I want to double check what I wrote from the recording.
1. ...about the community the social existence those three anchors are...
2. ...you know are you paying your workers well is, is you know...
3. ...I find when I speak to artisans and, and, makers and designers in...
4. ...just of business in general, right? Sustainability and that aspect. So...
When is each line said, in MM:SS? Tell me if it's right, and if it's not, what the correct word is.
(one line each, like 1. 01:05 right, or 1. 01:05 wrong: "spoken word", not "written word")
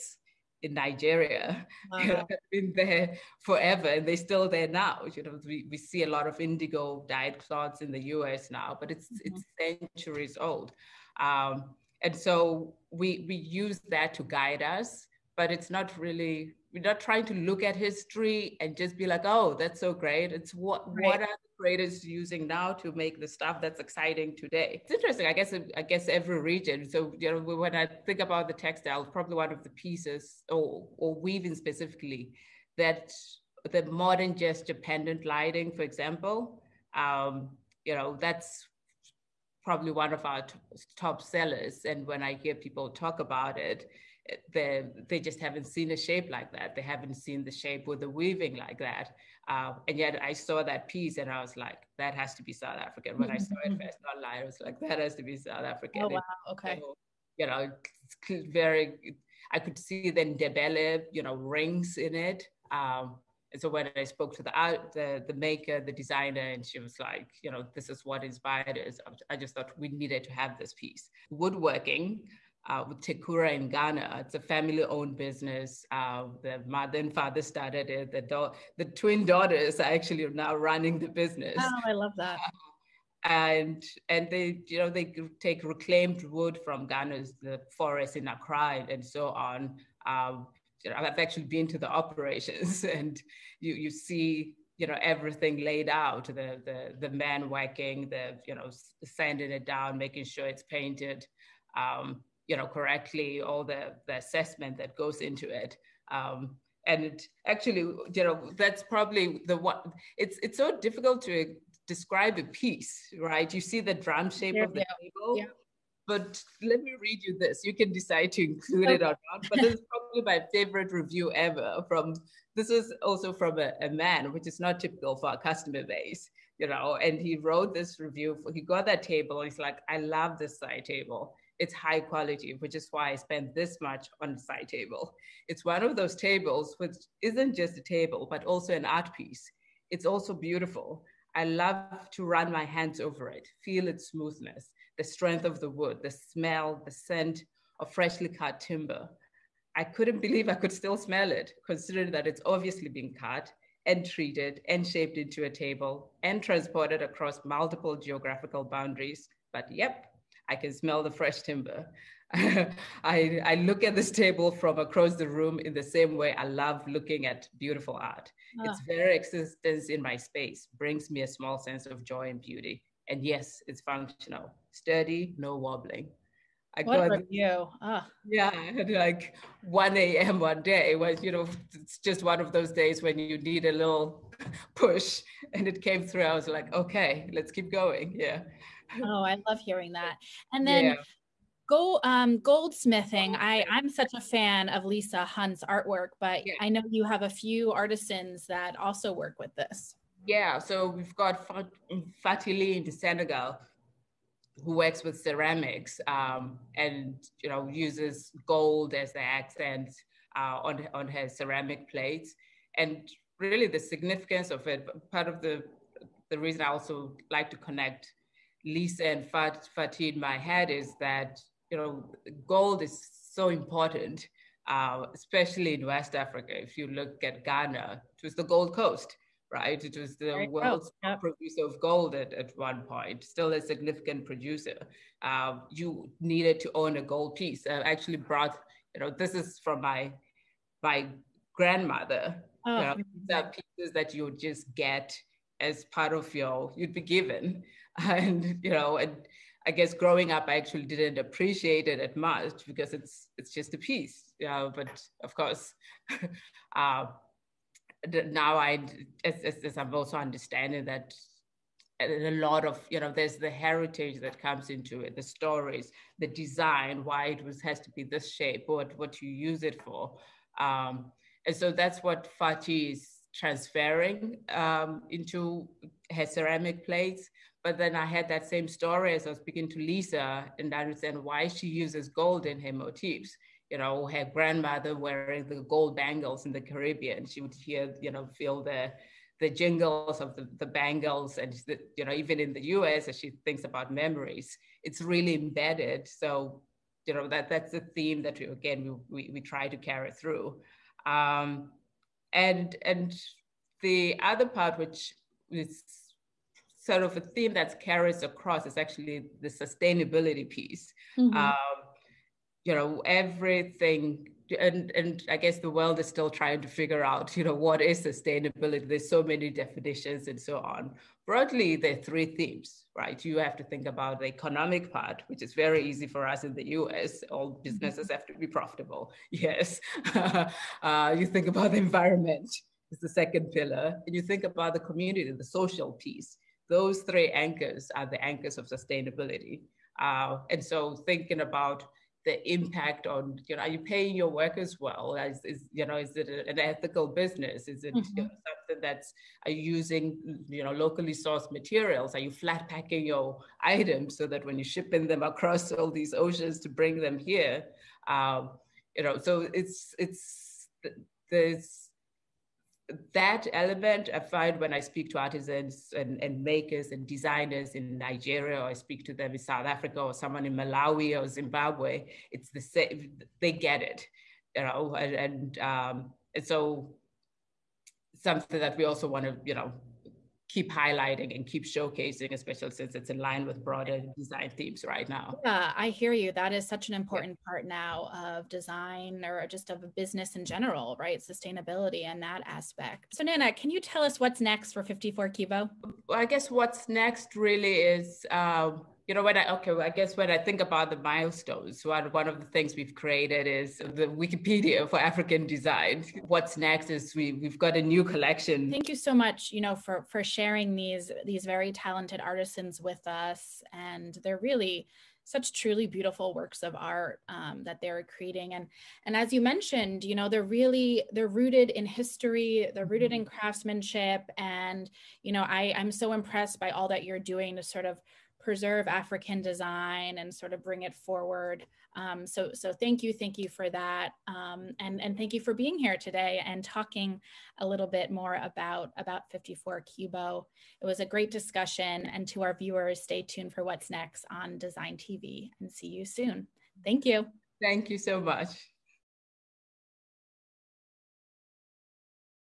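1. 05:34 wrong: "piece", not "existence"
2. 05:43 right
3. 06:04 right
4. 06:29 right.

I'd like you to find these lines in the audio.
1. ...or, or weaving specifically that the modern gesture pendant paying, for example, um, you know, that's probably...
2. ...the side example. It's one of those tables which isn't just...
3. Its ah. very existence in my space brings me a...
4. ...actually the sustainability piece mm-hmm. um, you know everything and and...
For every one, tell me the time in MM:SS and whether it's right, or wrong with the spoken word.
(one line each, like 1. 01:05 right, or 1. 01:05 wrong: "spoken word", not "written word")
1. 00:30 wrong: "lighting", not "paying"
2. 02:14 wrong: "table", not "example"
3. 02:48 right
4. 05:08 right.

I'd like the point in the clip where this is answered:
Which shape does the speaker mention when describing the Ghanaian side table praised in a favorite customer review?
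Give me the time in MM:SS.
01:53.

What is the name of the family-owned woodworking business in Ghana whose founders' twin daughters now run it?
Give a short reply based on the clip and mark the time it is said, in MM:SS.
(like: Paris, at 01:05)
Tekura, at 01:13.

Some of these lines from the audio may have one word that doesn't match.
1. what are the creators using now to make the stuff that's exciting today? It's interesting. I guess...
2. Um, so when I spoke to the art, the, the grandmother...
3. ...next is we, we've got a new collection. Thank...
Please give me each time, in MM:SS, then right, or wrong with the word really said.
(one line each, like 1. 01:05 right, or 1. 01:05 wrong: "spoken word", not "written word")
1. 00:21 right
2. 01:02 wrong: "maker", not "grandmother"
3. 06:46 right.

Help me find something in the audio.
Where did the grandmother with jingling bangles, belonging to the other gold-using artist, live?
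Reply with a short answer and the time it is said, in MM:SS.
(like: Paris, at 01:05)
The Caribbean, at 04:46.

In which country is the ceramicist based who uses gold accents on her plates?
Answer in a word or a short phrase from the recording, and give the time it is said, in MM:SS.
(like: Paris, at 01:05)
Senegal, at 03:22.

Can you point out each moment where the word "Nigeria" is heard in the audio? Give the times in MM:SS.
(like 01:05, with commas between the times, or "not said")
00:00, 06:07.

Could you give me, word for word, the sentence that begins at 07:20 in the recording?
It was a great discussion, and to our viewers, stay tuned for what's next on Design TV, and see you soon.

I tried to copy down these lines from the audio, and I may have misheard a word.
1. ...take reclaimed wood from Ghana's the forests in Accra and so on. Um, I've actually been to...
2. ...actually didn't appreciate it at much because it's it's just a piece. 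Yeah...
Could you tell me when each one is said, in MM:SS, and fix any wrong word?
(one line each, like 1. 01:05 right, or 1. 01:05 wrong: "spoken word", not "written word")
1. 01:25 right
2. 04:10 right.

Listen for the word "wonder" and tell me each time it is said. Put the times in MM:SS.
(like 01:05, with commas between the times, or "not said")
not said.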